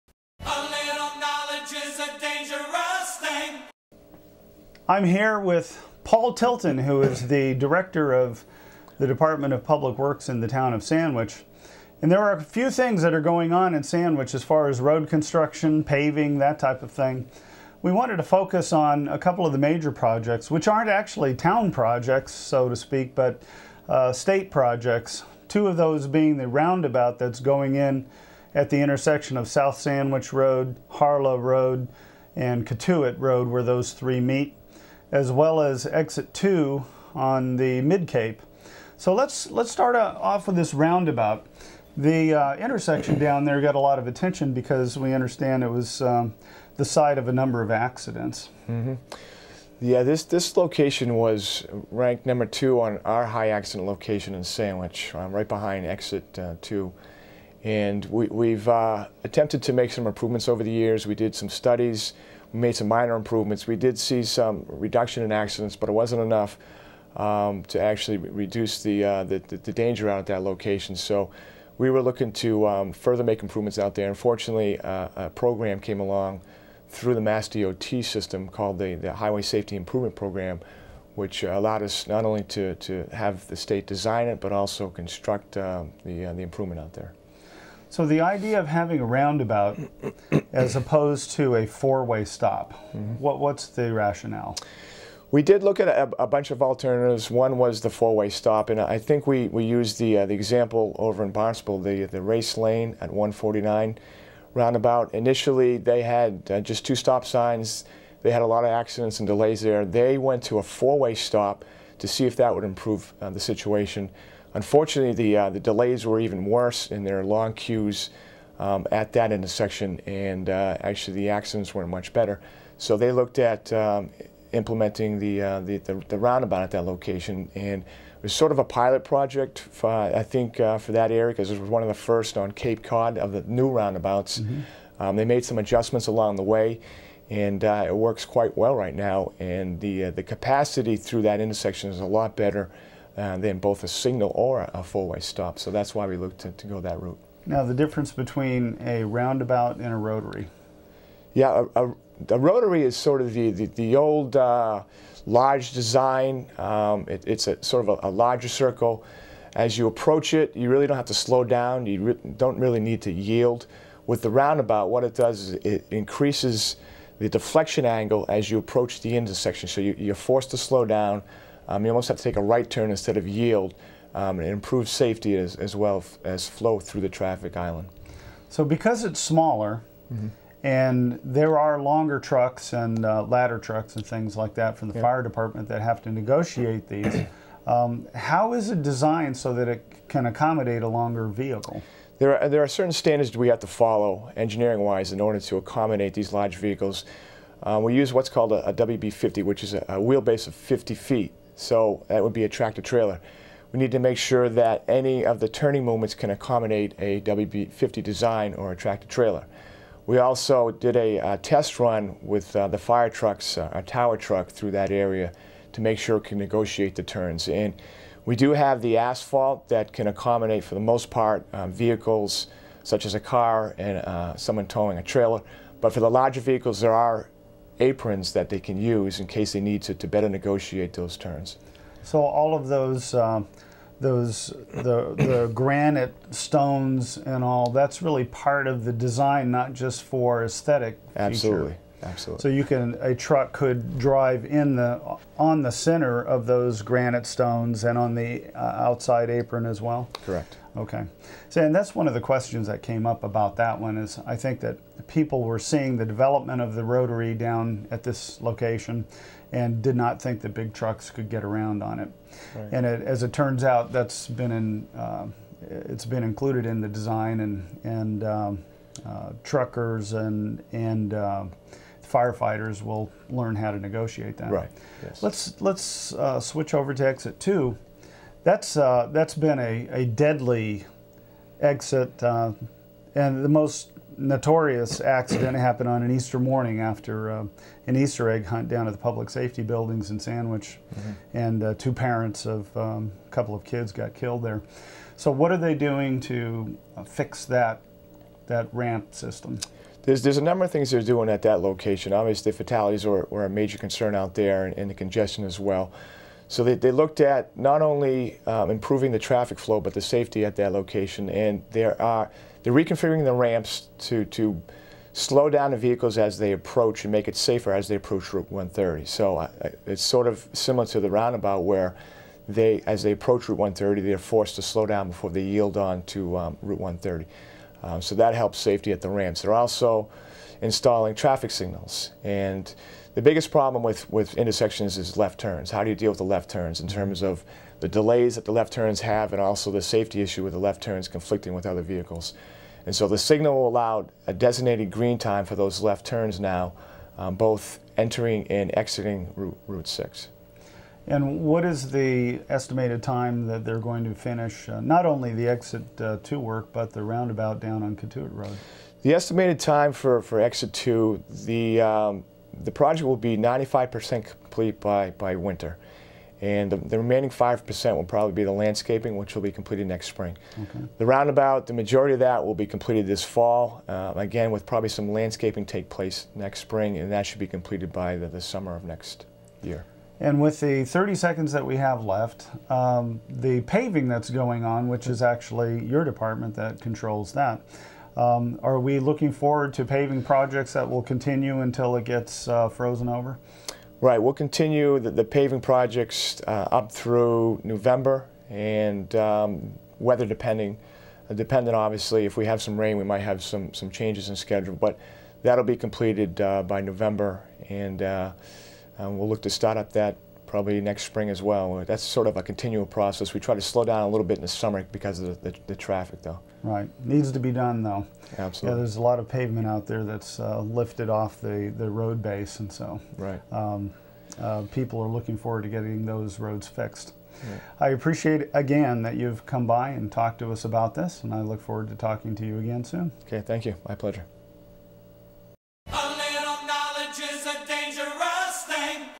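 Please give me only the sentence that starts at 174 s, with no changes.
Um, and improve safety as, as well as flow through the traffic island.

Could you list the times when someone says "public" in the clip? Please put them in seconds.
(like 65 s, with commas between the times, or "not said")
9 s, 288 s.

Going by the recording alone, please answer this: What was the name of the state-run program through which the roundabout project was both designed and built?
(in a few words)
Highway Safety Improvement Program.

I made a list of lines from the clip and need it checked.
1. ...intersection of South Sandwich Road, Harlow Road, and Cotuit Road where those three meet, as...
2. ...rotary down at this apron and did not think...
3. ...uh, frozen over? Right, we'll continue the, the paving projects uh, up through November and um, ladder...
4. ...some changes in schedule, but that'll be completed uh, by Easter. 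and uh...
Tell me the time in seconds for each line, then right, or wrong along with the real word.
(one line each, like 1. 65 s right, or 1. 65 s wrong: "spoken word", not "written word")
1. 28 s right
2. 256 s wrong: "location", not "apron"
3. 392 s wrong: "weather", not "ladder"
4. 403 s wrong: "November", not "Easter".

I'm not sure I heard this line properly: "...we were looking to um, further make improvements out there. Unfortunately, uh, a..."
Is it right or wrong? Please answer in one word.
right.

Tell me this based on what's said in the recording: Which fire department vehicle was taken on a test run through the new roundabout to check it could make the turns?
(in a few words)
tower truck.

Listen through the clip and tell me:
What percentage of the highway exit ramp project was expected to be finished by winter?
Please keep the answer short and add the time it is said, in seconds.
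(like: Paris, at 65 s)
95%, at 363 s.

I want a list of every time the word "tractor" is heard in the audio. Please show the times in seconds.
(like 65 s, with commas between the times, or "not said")
202 s, 208 s.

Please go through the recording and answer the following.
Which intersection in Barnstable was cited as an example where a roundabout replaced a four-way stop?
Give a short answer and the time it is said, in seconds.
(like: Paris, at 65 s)
Race Lane at 149, at 102 s.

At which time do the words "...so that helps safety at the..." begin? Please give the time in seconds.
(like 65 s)
328 s.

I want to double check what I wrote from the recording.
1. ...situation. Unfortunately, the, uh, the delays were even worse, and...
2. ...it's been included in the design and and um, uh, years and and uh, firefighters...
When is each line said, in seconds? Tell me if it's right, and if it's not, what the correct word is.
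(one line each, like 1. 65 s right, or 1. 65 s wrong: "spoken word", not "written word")
1. 113 s right
2. 265 s wrong: "truckers", not "years".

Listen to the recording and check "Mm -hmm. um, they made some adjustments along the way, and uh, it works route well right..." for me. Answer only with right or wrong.
wrong.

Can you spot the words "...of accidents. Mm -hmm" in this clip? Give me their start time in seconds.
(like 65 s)
47 s.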